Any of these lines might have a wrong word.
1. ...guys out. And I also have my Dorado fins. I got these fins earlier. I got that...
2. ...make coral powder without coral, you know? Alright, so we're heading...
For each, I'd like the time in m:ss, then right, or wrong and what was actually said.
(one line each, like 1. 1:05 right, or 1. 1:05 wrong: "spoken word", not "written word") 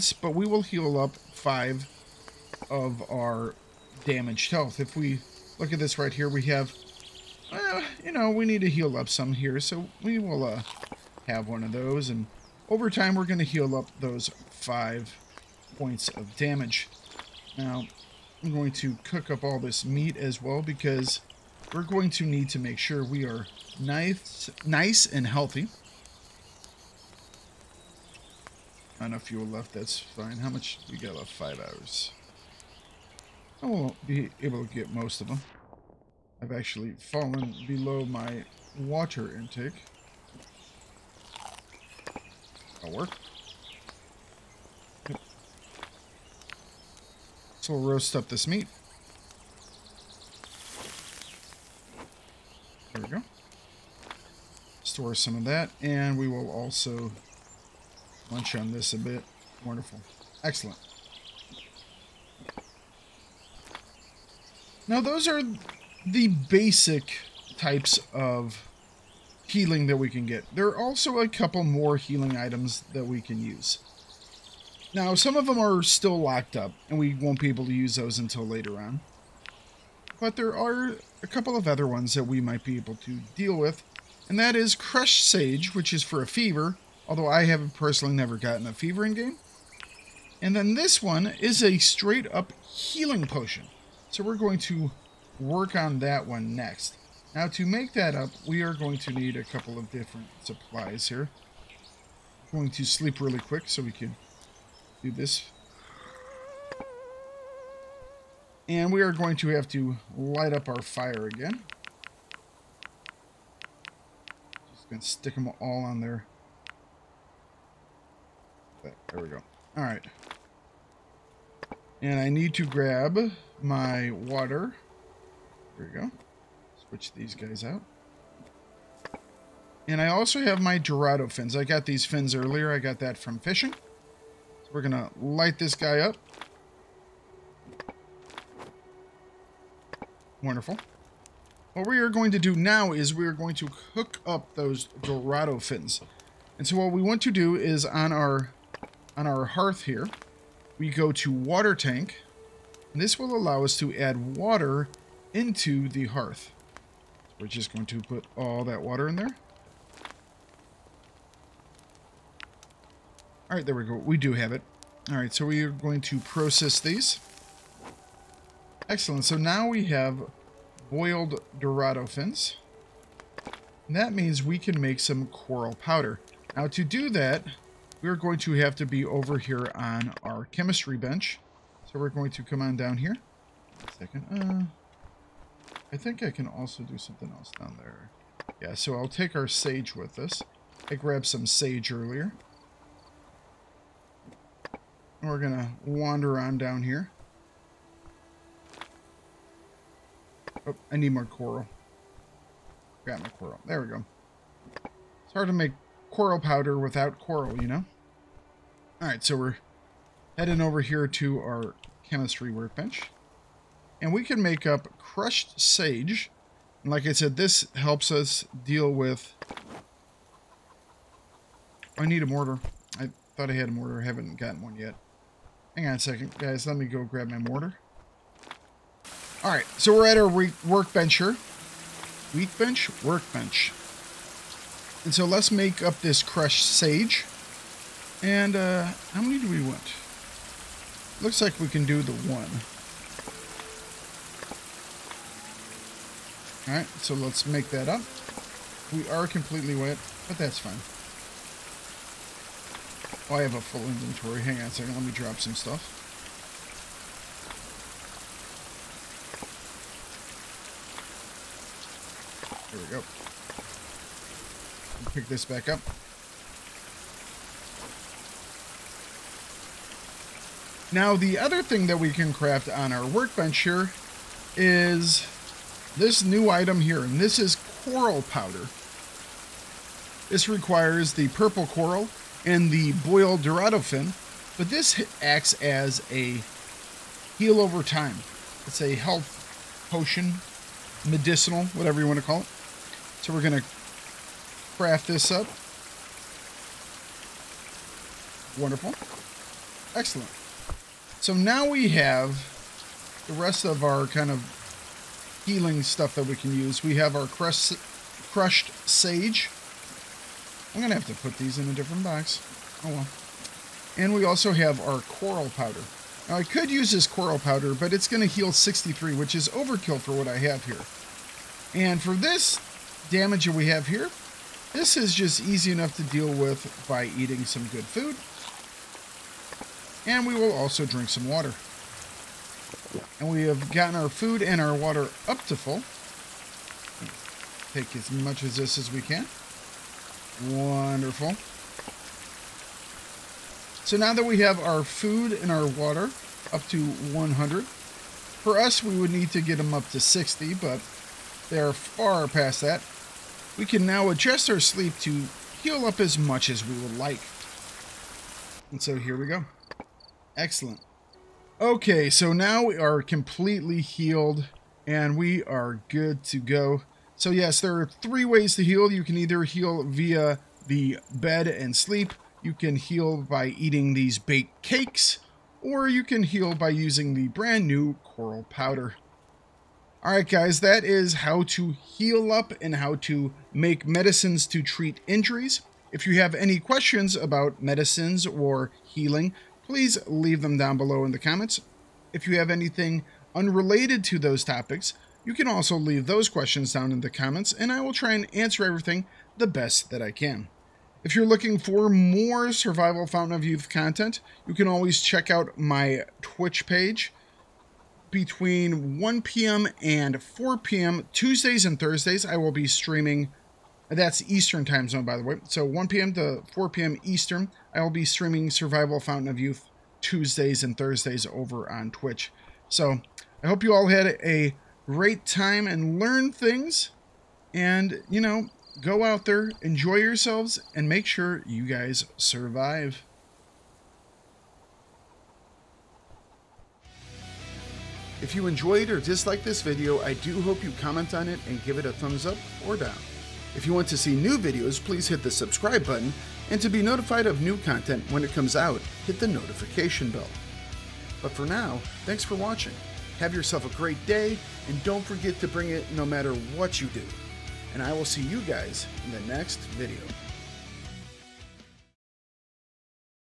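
1. 2:07 right
2. 3:25 right.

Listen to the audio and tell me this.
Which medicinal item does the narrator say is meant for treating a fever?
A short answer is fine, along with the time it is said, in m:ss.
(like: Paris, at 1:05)
Crush Sage, at 1:24.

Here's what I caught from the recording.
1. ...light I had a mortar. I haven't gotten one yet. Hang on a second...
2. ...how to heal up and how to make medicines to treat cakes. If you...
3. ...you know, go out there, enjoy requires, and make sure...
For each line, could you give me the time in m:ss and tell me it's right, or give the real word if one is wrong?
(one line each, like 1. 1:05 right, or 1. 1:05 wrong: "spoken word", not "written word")
1. 3:43 wrong: "thought", not "light"
2. 6:21 wrong: "injuries", not "cakes"
3. 7:08 wrong: "yourselves", not "requires".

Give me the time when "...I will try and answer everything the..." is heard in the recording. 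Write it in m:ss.
6:37.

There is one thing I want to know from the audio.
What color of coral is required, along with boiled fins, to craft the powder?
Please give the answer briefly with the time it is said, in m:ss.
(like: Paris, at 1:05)
Purple, at 4:41.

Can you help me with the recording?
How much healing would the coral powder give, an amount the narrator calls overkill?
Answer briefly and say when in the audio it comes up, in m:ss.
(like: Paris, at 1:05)
63, at 5:18.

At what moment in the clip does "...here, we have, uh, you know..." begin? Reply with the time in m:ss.
0:06.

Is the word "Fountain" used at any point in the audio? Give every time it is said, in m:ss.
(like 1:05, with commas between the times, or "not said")
6:43, 6:58.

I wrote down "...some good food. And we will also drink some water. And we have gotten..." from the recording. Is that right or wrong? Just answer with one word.
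right.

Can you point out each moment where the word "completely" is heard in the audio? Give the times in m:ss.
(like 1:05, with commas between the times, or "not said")
4:09, 6:03.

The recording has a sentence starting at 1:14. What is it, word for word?
Now, some of them are still locked up, and we won't be able to use those until later on.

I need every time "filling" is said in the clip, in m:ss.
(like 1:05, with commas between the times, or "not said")
not said.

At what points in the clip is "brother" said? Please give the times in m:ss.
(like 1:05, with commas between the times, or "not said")
not said.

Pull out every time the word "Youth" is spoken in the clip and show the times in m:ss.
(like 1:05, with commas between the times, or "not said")
6:43, 6:59.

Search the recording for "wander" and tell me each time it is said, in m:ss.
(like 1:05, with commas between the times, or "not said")
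3:15.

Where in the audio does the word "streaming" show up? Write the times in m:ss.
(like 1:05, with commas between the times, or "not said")
6:52, 6:58.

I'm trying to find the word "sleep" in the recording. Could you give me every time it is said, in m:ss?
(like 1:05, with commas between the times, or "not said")
1:42, 5:54, 6:11.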